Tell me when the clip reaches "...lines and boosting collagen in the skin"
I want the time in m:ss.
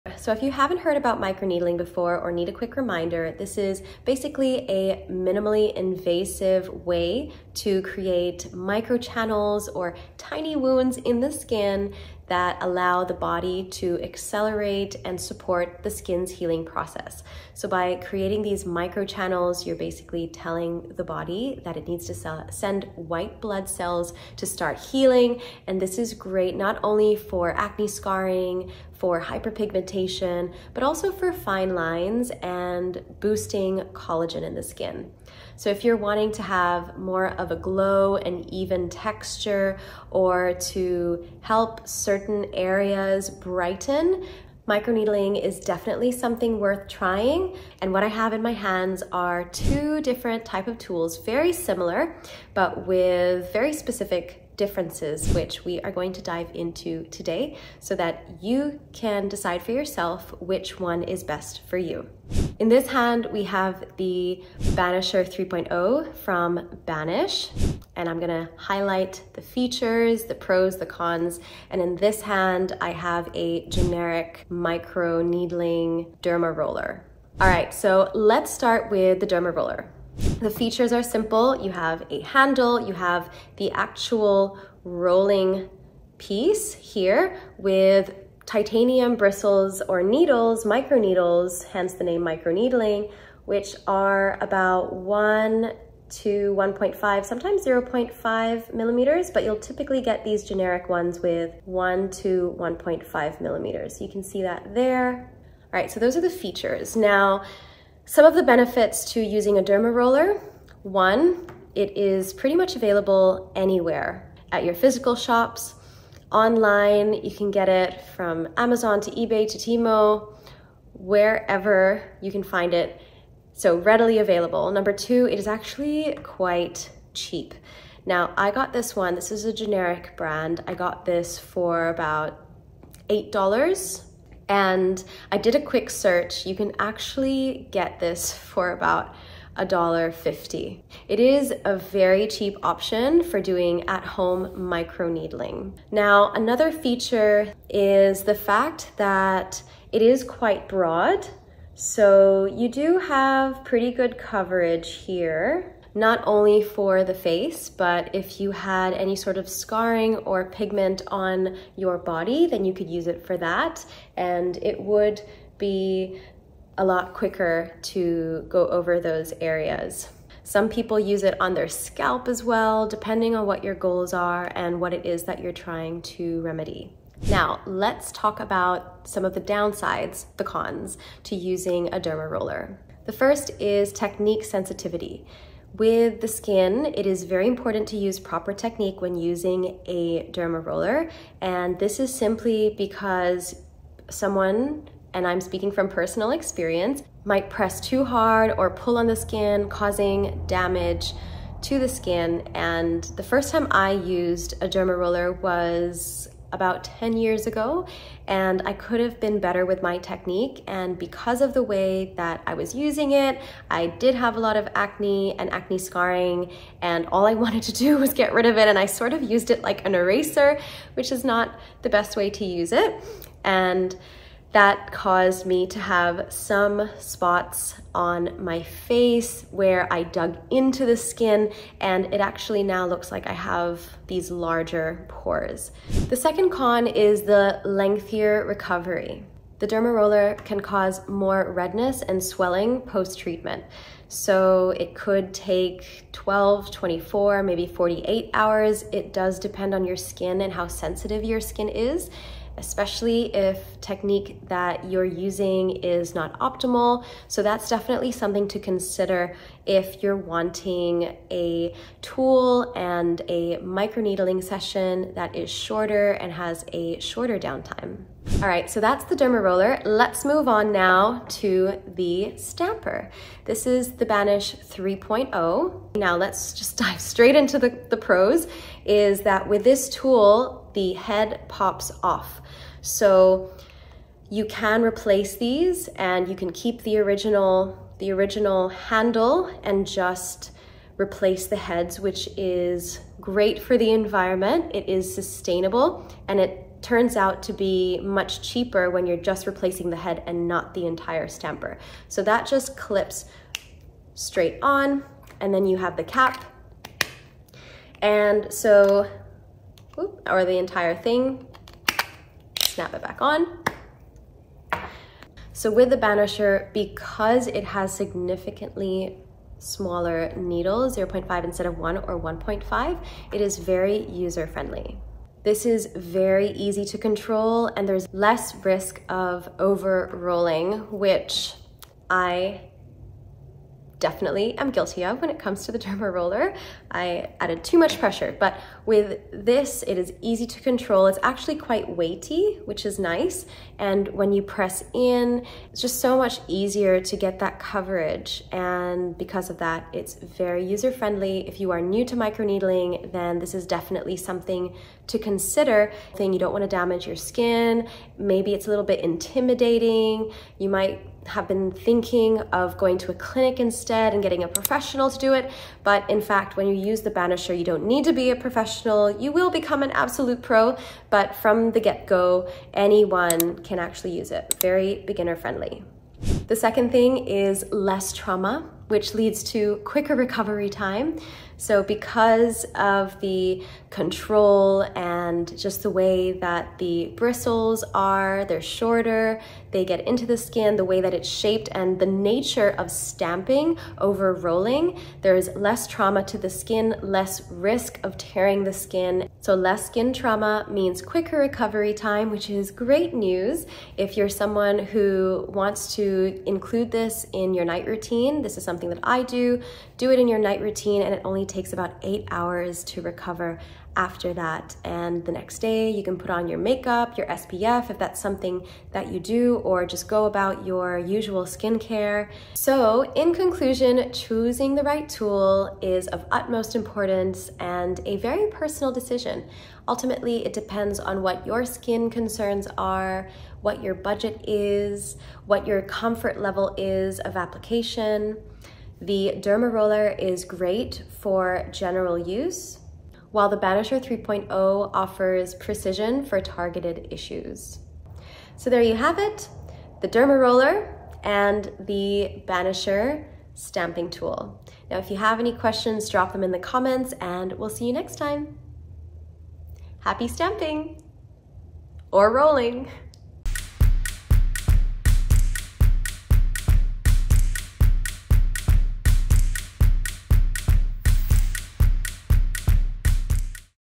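0:31.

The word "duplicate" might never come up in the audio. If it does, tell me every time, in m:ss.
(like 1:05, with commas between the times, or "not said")
not said.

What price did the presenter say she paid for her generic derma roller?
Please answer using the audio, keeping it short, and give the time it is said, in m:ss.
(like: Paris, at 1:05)
$8, at 2:13.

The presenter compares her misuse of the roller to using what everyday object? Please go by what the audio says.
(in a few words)
an eraser.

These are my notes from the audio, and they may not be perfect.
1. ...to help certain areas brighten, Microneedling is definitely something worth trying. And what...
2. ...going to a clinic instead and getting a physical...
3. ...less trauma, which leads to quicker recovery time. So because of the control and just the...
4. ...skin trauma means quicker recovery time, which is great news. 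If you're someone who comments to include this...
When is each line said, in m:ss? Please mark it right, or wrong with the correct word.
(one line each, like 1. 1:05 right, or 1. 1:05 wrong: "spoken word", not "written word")
1. 0:40 right
2. 6:02 wrong: "professional", not "physical"
3. 6:17 right
4. 6:39 wrong: "wants", not "comments".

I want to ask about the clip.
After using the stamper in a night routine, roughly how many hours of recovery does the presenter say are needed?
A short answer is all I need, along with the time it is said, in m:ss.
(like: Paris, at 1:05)
8 hours, at 6:52.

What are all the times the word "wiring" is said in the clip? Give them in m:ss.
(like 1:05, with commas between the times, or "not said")
not said.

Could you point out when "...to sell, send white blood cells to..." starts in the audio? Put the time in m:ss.
0:22.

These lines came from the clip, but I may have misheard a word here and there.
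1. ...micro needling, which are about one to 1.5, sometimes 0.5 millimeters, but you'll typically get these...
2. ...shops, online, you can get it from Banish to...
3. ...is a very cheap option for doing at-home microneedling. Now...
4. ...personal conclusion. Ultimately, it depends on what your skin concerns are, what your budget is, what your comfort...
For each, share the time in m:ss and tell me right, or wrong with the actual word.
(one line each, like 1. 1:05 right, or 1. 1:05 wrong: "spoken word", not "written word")
1. 1:32 right
2. 1:55 wrong: "Amazon", not "Banish"
3. 2:21 right
4. 7:08 wrong: "decision", not "conclusion".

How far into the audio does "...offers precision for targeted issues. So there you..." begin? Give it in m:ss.
7:24.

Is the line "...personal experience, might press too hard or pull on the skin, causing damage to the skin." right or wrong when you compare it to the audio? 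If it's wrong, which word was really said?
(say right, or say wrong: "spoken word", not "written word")
right.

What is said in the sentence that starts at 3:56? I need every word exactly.
The second con is the lengthier recovery.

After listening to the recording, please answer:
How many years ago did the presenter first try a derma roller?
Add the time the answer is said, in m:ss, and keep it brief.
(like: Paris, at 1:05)
10 years, at 3:26.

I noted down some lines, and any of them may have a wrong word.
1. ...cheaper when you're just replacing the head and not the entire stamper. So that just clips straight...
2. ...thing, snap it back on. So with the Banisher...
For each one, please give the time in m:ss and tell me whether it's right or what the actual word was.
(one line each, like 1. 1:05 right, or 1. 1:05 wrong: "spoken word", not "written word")
1. 4:58 right
2. 5:10 right.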